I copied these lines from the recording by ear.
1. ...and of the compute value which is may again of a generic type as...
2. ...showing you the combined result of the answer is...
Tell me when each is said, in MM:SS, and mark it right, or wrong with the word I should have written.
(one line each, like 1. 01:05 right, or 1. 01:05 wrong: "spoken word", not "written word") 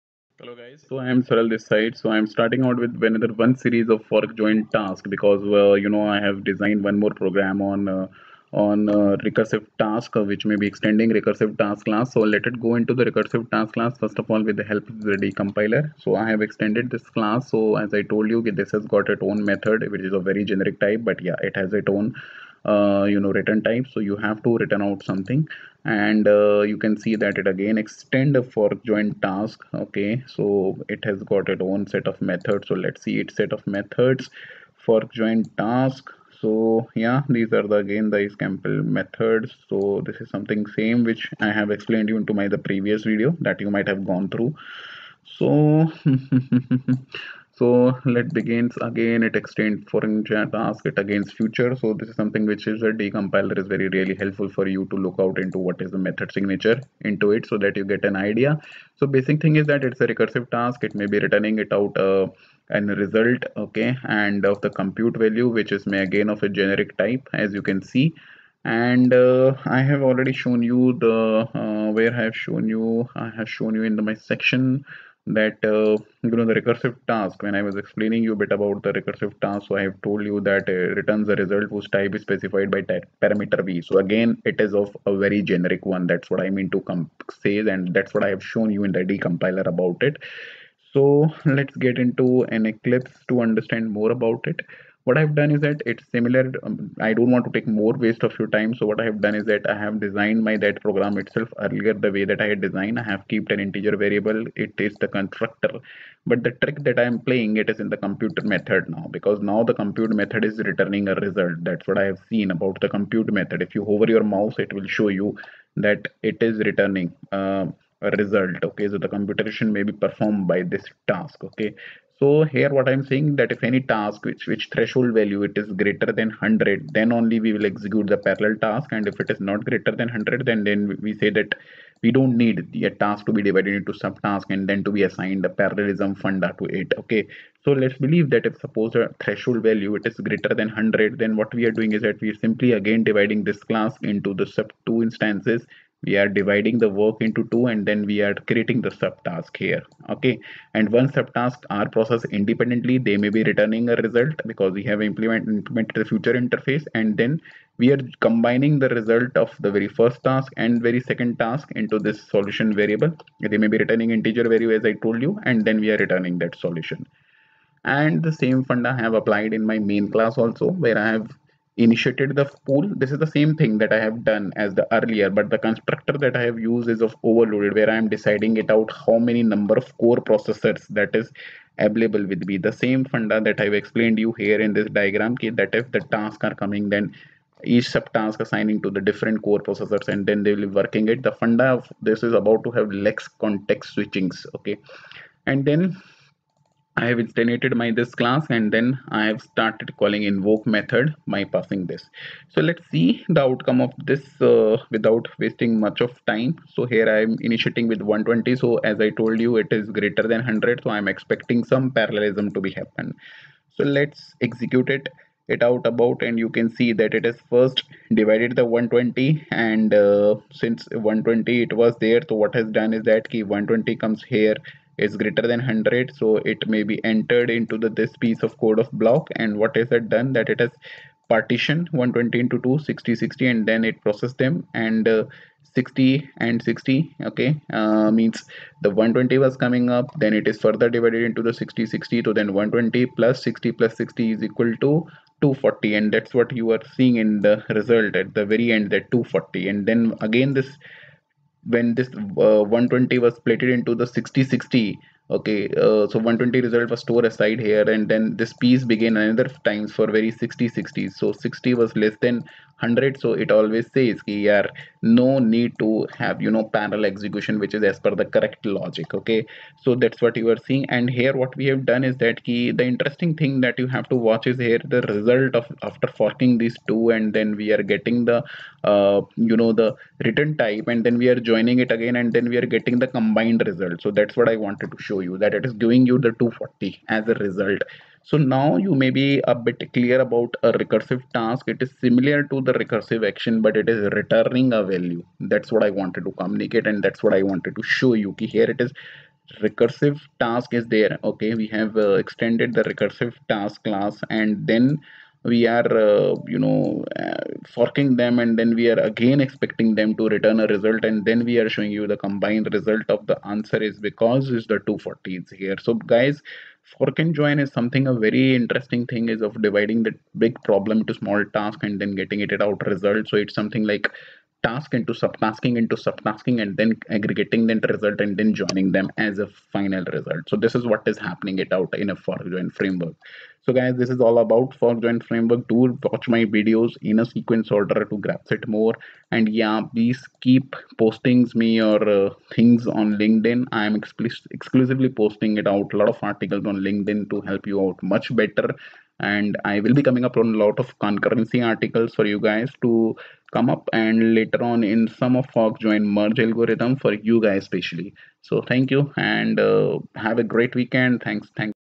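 1. 01:04 right
2. 05:11 right.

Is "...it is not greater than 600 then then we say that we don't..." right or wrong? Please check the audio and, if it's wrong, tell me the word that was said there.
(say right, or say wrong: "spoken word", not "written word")
wrong: "100", not "600".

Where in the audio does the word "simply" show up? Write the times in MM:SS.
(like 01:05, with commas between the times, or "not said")
02:22.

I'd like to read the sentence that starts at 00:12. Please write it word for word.
So let it go into the recursive task class first of all with the help of the decompiler.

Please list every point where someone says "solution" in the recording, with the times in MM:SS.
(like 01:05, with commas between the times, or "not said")
02:42, 02:46.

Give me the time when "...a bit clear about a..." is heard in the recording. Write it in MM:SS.
04:49.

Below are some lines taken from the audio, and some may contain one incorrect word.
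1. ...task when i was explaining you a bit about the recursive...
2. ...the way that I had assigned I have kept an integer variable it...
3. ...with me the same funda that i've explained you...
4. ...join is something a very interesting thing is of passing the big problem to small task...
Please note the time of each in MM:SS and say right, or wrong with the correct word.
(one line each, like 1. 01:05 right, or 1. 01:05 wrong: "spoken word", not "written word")
1. 01:17 right
2. 01:41 wrong: "designed", not "assigned"
3. 03:02 right
4. 05:17 wrong: "dividing", not "passing".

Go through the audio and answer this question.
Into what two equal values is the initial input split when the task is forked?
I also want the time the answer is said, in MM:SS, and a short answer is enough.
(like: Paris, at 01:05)
60 and 60, at 03:52.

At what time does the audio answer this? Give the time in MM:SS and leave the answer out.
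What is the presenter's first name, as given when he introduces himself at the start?
00:01.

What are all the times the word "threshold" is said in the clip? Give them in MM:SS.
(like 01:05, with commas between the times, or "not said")
02:04, 02:19.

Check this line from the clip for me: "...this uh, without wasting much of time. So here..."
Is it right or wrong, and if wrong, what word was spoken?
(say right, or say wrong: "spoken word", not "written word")
right.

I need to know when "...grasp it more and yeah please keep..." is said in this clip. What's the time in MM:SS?
05:38.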